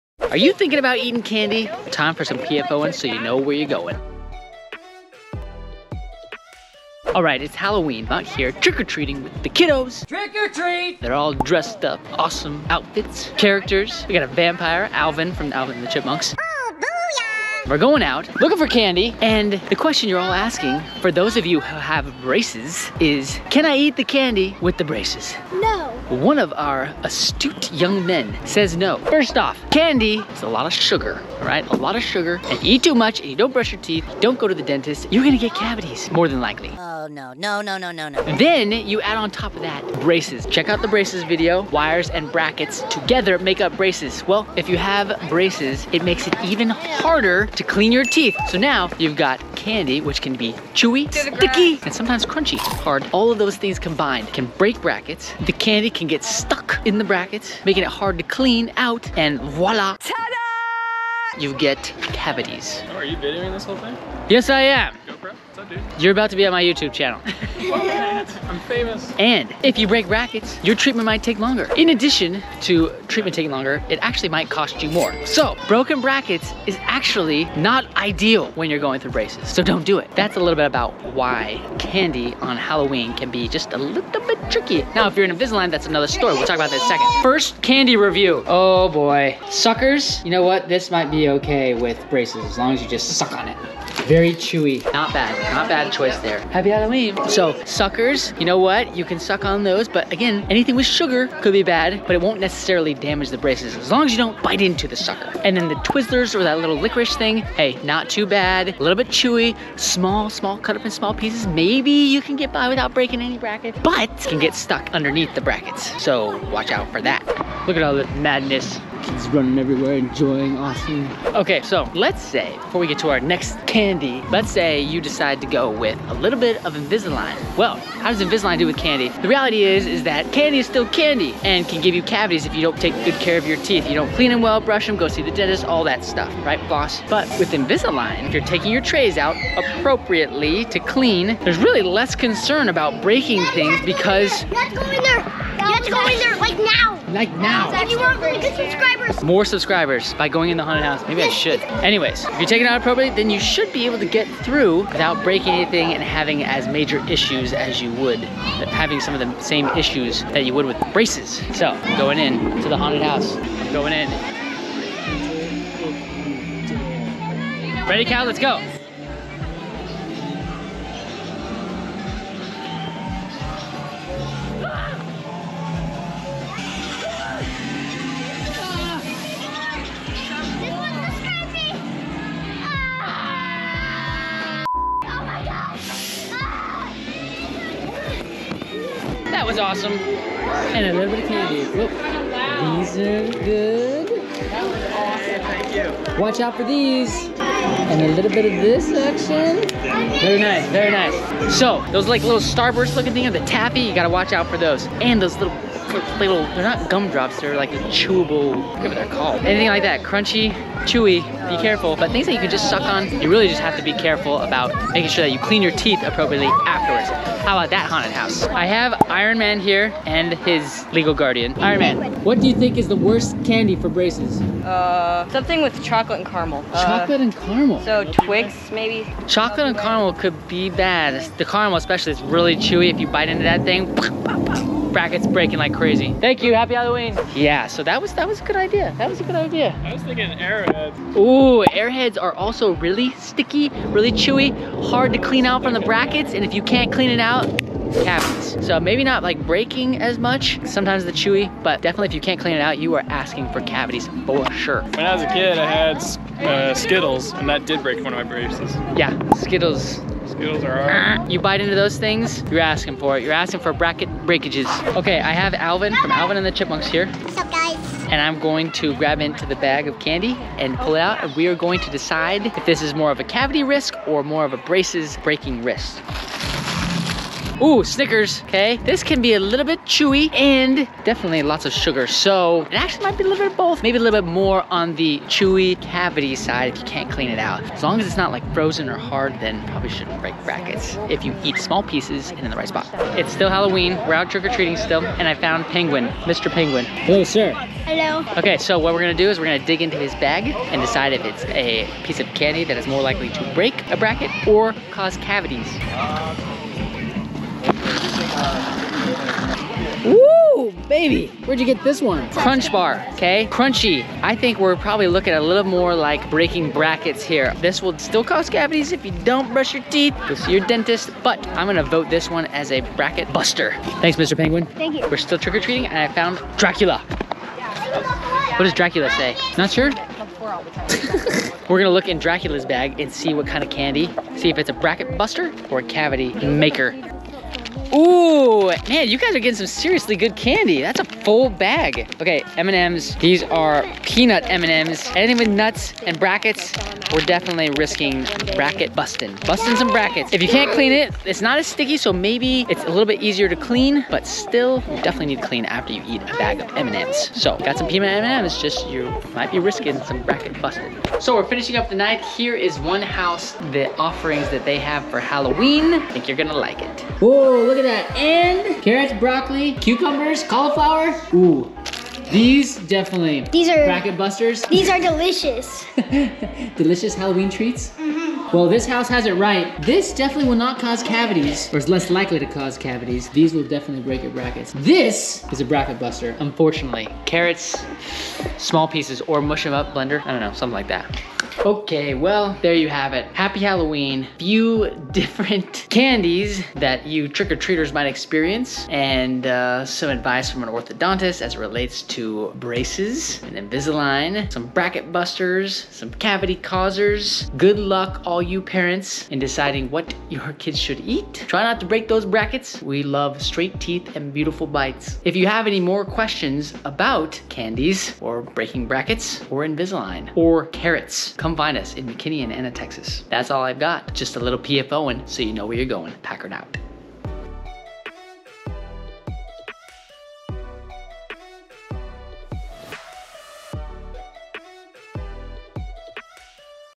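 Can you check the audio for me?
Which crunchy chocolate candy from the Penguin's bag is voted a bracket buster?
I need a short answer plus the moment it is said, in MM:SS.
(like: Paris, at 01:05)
Crunch bar, at 05:12.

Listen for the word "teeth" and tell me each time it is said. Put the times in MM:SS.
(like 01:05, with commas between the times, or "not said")
00:33, 00:48, 02:13, 03:35, 05:19, 06:53.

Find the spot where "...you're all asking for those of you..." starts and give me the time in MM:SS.
00:20.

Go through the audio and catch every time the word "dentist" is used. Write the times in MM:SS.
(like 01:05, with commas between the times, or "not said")
00:34, 02:15, 05:20.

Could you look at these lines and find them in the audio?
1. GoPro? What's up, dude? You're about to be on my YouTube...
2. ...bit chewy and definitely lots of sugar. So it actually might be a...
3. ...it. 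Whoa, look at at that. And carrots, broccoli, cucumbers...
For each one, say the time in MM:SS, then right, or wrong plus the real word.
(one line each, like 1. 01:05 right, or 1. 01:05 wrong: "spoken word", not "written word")
1. 01:05 right
2. 04:39 right
3. 06:06 right.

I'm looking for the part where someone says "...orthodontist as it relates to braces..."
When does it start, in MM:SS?
06:40.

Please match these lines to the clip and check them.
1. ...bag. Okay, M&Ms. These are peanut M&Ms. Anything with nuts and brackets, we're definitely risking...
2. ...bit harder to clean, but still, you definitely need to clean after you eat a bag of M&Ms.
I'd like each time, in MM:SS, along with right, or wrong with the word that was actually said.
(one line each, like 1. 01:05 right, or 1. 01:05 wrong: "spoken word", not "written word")
1. 05:41 right
2. 05:53 wrong: "easier", not "harder".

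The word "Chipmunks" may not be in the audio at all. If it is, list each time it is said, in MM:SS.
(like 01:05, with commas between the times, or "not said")
00:15, 04:26.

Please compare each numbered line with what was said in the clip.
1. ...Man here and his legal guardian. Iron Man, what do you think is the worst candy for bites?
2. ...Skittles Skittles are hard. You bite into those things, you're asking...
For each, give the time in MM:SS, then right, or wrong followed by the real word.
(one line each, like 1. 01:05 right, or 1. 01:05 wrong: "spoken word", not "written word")
1. 03:39 wrong: "braces", not "bites"
2. 04:19 right.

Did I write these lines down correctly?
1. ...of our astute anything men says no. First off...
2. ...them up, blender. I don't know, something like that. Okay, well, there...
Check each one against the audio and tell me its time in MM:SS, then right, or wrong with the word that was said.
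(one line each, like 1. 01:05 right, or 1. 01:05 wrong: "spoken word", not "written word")
1. 00:26 wrong: "young", not "anything"
2. 06:29 right.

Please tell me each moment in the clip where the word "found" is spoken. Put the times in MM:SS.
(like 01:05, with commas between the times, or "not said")
04:55, 05:26.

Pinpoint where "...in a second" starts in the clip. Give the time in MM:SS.
01:26.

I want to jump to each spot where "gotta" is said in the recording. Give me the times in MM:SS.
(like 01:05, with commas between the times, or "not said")
03:23.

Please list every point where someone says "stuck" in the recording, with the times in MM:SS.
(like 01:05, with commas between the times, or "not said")
00:56, 01:54.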